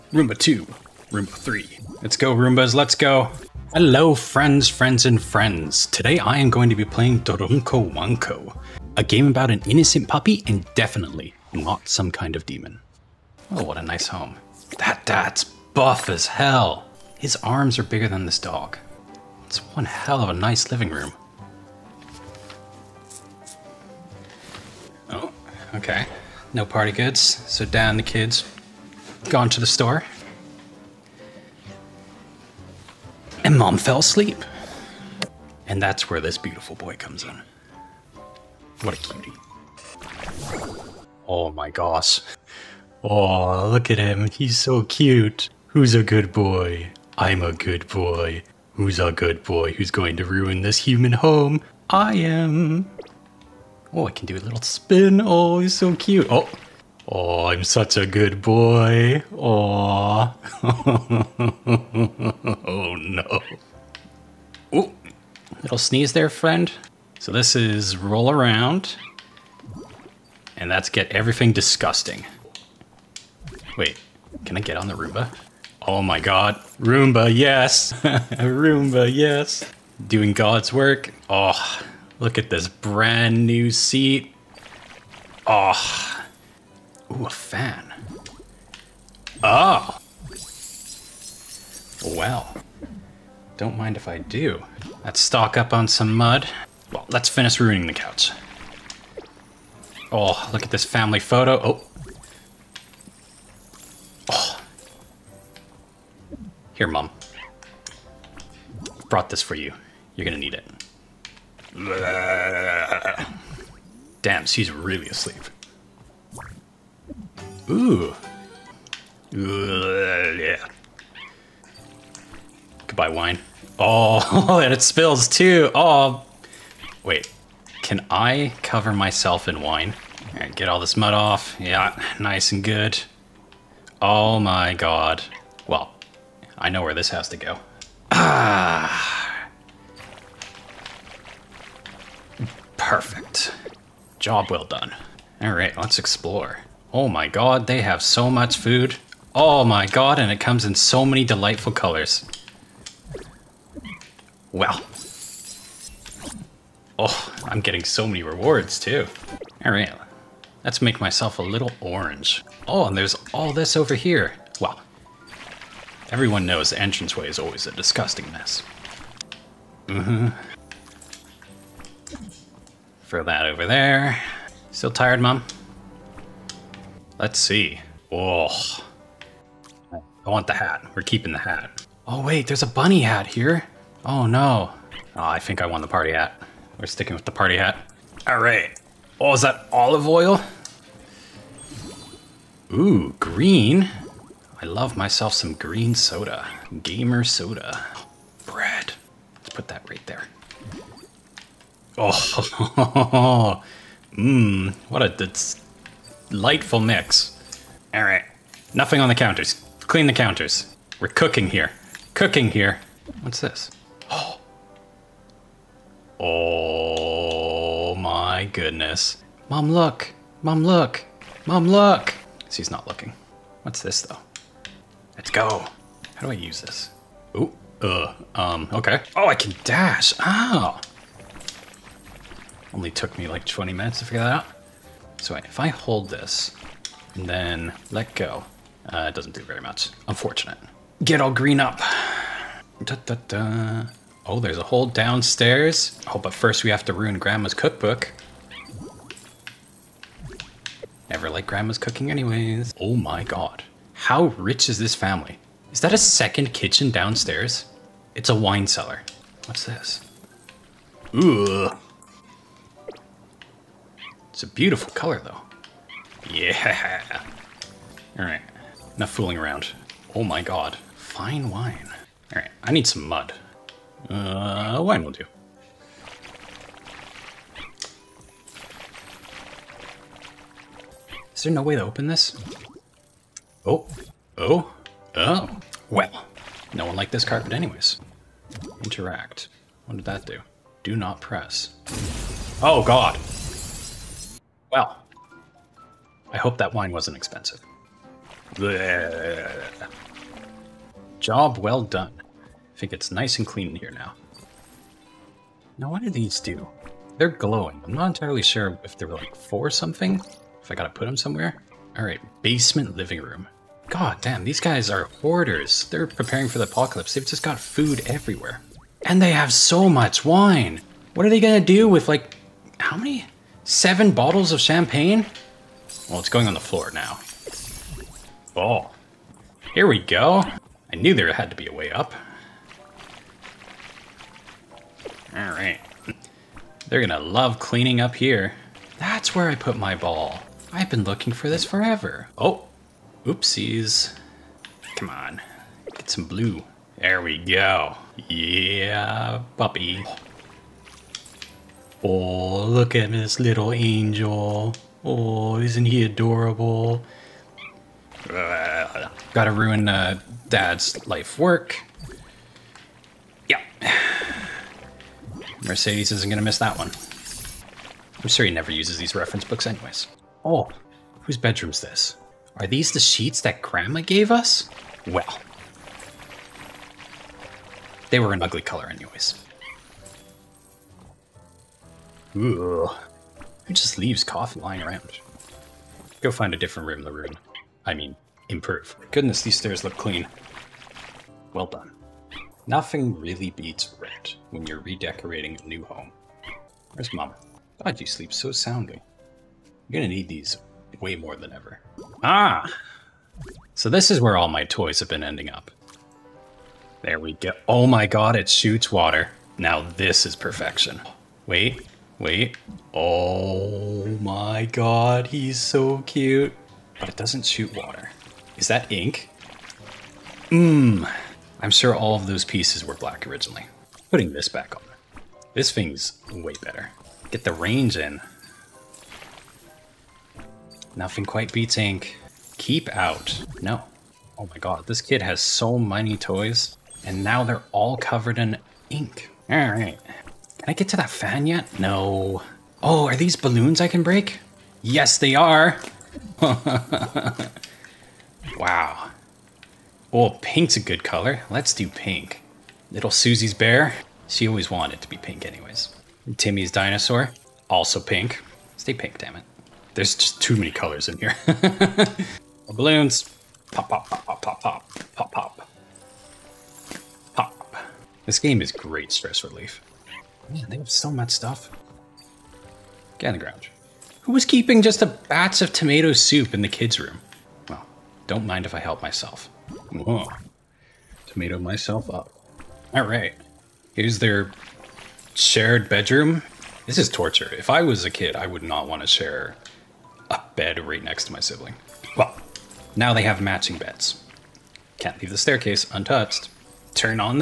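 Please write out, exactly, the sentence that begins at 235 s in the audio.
So if I hold this and then let go, uh, it doesn't do very much.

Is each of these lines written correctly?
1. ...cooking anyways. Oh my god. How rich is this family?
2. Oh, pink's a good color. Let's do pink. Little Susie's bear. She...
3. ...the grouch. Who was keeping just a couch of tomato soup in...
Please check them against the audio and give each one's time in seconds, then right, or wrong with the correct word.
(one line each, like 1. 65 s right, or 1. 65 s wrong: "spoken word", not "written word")
1. 251 s right
2. 450 s right
3. 473 s wrong: "batch", not "couch".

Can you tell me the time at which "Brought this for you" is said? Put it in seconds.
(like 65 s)
109 s.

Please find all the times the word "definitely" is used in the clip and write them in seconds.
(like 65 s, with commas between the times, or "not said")
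10 s.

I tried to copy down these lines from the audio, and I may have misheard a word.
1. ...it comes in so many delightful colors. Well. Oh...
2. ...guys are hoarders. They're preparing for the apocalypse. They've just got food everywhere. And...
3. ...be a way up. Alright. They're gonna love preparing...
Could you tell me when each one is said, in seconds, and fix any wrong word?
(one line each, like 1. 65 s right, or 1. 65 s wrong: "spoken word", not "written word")
1. 150 s right
2. 314 s right
3. 331 s wrong: "cleaning", not "preparing".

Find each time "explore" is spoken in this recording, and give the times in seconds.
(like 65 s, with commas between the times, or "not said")
145 s.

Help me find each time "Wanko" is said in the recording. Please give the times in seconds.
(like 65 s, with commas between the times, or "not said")
7 s.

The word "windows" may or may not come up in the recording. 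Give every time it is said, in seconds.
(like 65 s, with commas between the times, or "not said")
not said.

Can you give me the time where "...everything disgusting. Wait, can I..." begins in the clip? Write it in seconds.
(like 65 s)
71 s.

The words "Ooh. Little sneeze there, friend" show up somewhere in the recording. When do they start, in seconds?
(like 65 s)
64 s.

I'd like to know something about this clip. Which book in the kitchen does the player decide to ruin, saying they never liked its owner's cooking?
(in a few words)
Grandma's cookbook.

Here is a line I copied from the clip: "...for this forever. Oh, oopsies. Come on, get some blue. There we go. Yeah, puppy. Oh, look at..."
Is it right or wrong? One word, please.
right.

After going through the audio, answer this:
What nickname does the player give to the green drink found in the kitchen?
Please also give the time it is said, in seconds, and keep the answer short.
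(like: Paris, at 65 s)
Gamer soda, at 196 s.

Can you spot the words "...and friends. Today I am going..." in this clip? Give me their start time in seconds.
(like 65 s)
5 s.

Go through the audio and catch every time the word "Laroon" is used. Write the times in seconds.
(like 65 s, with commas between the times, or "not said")
387 s.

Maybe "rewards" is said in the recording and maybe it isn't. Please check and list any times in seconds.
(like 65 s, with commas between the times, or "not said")
158 s.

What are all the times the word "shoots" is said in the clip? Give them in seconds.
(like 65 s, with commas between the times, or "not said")
408 s, 417 s.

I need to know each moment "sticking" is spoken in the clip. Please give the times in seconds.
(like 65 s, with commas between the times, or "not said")
186 s.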